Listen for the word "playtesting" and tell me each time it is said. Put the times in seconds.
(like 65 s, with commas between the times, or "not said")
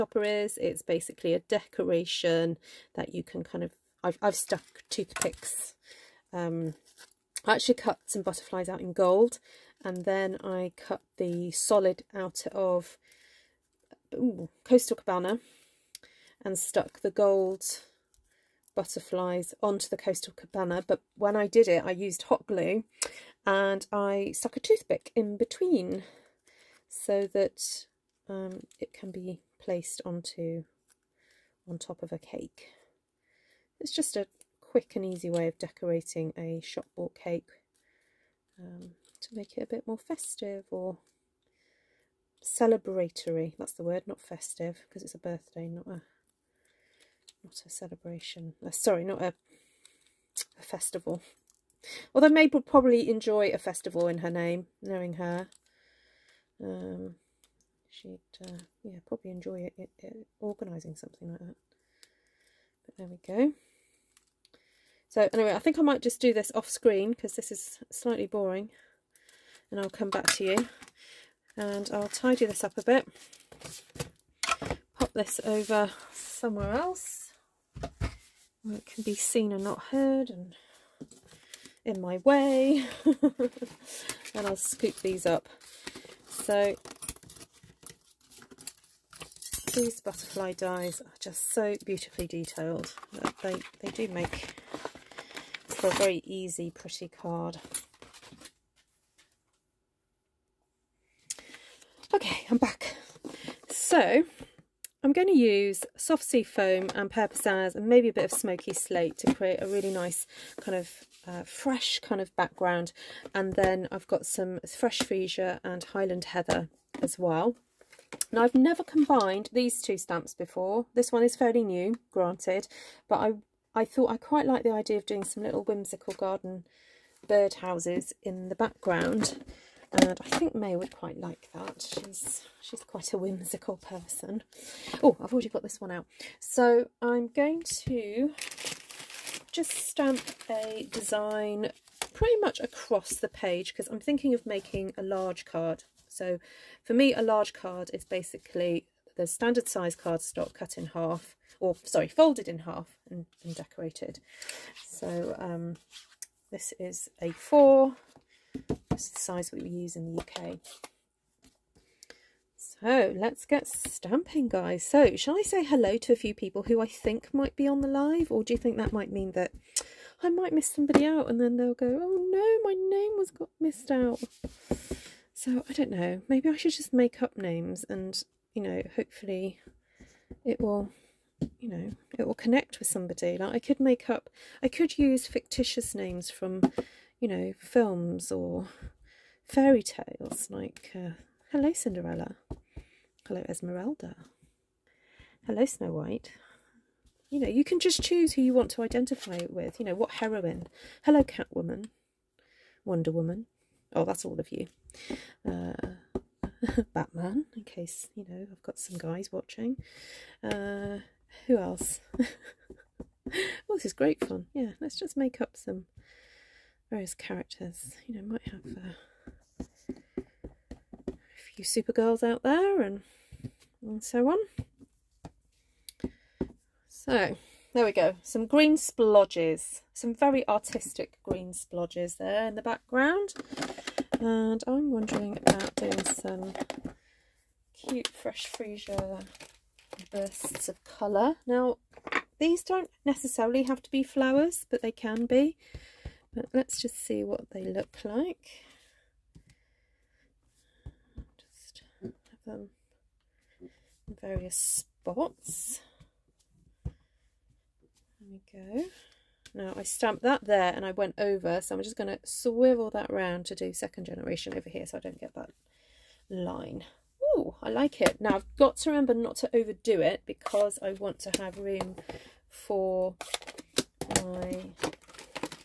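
not said.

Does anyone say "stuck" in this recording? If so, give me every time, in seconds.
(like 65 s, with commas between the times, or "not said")
4 s, 16 s, 24 s.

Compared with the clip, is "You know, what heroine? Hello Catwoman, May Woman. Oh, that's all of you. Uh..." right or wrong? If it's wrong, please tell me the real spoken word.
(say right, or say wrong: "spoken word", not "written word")
wrong: "Wonder", not "May".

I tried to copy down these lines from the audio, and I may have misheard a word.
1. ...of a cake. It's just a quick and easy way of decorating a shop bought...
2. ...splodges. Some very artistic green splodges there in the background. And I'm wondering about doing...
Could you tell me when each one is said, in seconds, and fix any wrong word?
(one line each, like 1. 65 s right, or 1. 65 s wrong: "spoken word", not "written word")
1. 32 s right
2. 228 s right.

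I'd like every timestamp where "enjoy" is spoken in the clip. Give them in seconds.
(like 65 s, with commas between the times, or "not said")
53 s, 59 s.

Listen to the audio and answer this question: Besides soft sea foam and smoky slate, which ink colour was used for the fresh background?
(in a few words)
Pear Pizzazz.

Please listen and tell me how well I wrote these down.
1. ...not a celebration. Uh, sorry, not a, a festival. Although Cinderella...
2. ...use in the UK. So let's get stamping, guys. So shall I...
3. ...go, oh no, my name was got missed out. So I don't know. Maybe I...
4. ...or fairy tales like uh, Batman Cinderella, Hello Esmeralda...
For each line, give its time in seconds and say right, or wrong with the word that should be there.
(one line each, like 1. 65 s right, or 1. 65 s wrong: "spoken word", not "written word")
1. 47 s wrong: "Mabel", not "Cinderella"
2. 159 s right
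3. 171 s right
4. 188 s wrong: "Hello", not "Batman".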